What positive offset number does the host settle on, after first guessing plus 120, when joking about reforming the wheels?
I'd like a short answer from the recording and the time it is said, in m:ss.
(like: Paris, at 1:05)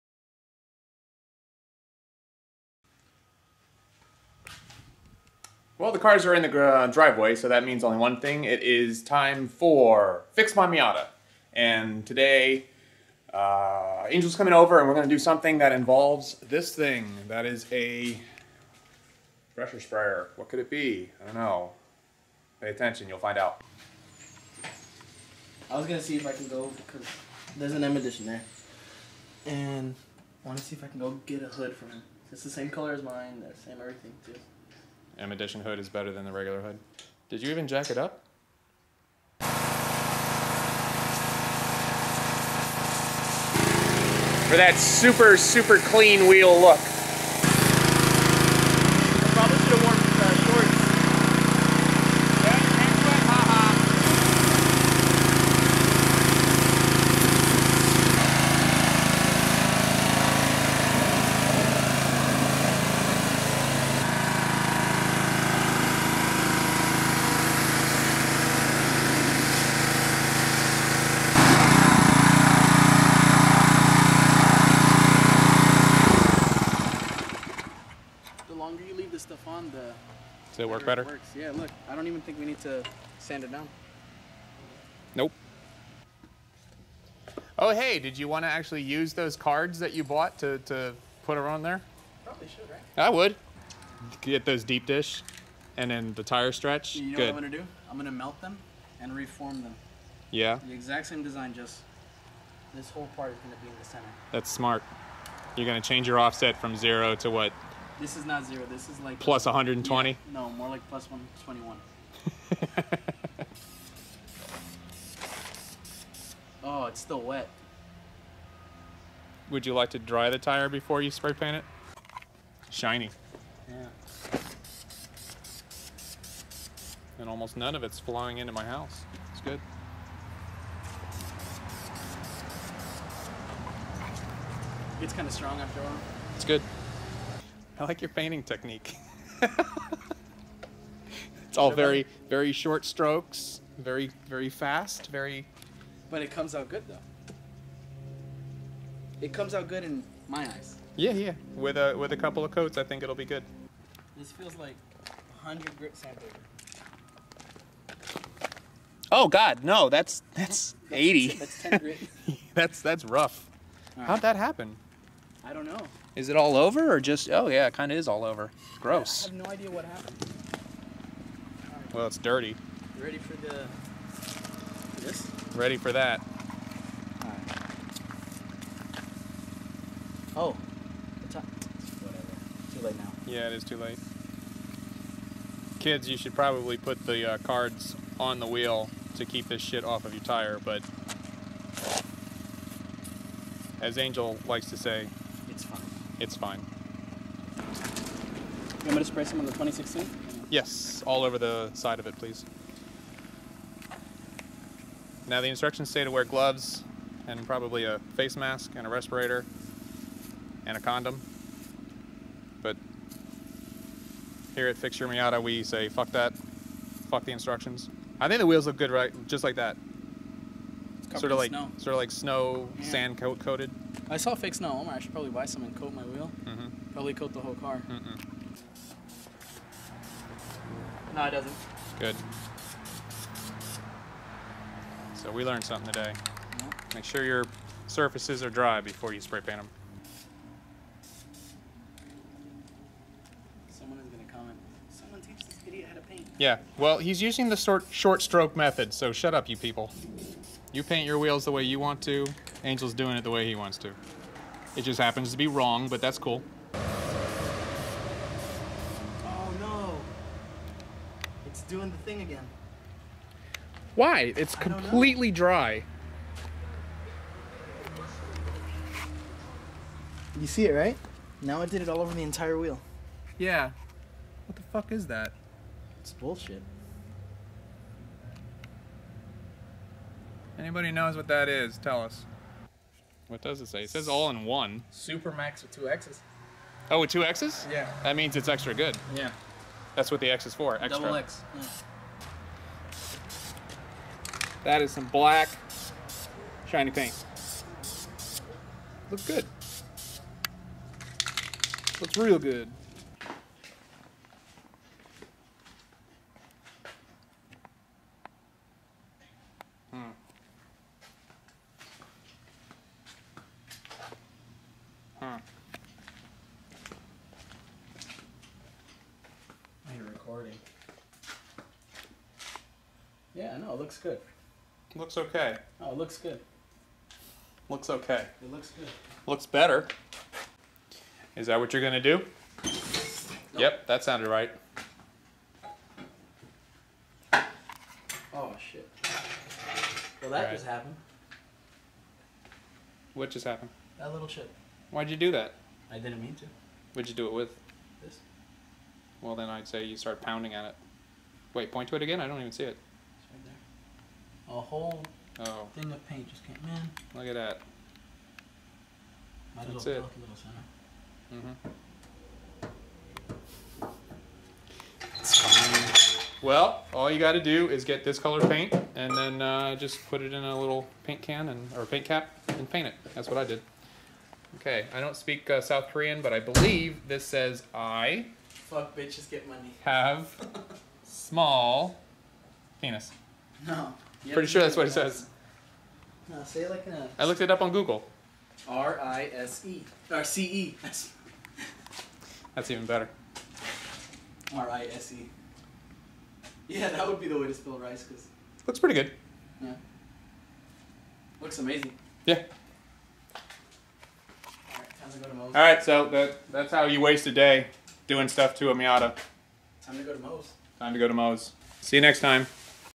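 +121, at 1:50.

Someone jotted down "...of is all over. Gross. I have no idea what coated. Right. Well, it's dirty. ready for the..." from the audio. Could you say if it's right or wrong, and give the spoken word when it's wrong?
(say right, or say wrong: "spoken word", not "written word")
wrong: "happened", not "coated".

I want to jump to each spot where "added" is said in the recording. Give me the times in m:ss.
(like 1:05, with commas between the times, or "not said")
not said.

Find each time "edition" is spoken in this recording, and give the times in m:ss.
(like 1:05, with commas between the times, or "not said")
0:27, 0:35.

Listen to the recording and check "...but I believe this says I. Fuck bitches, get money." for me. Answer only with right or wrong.
right.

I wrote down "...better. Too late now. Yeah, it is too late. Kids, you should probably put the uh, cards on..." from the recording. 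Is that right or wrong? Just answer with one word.
wrong.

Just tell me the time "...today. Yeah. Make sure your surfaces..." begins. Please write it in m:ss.
3:55.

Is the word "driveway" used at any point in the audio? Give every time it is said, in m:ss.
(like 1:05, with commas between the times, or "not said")
0:06.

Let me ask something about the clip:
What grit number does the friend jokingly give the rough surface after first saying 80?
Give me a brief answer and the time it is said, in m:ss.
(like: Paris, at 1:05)
10, at 2:41.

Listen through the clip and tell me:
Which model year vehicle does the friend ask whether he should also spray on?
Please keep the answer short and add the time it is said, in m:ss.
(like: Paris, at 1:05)
2016, at 3:19.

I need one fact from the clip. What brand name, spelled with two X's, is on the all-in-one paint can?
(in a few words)
Supermax.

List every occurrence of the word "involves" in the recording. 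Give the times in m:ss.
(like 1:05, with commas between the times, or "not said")
0:15.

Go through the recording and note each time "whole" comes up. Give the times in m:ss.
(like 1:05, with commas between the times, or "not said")
1:42, 3:47, 5:54.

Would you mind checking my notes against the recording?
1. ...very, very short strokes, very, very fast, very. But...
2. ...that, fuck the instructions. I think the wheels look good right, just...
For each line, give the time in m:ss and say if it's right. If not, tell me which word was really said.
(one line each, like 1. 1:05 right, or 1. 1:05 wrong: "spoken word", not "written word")
1. 2:21 right
2. 3:36 right.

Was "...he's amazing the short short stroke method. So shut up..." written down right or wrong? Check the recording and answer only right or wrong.
wrong.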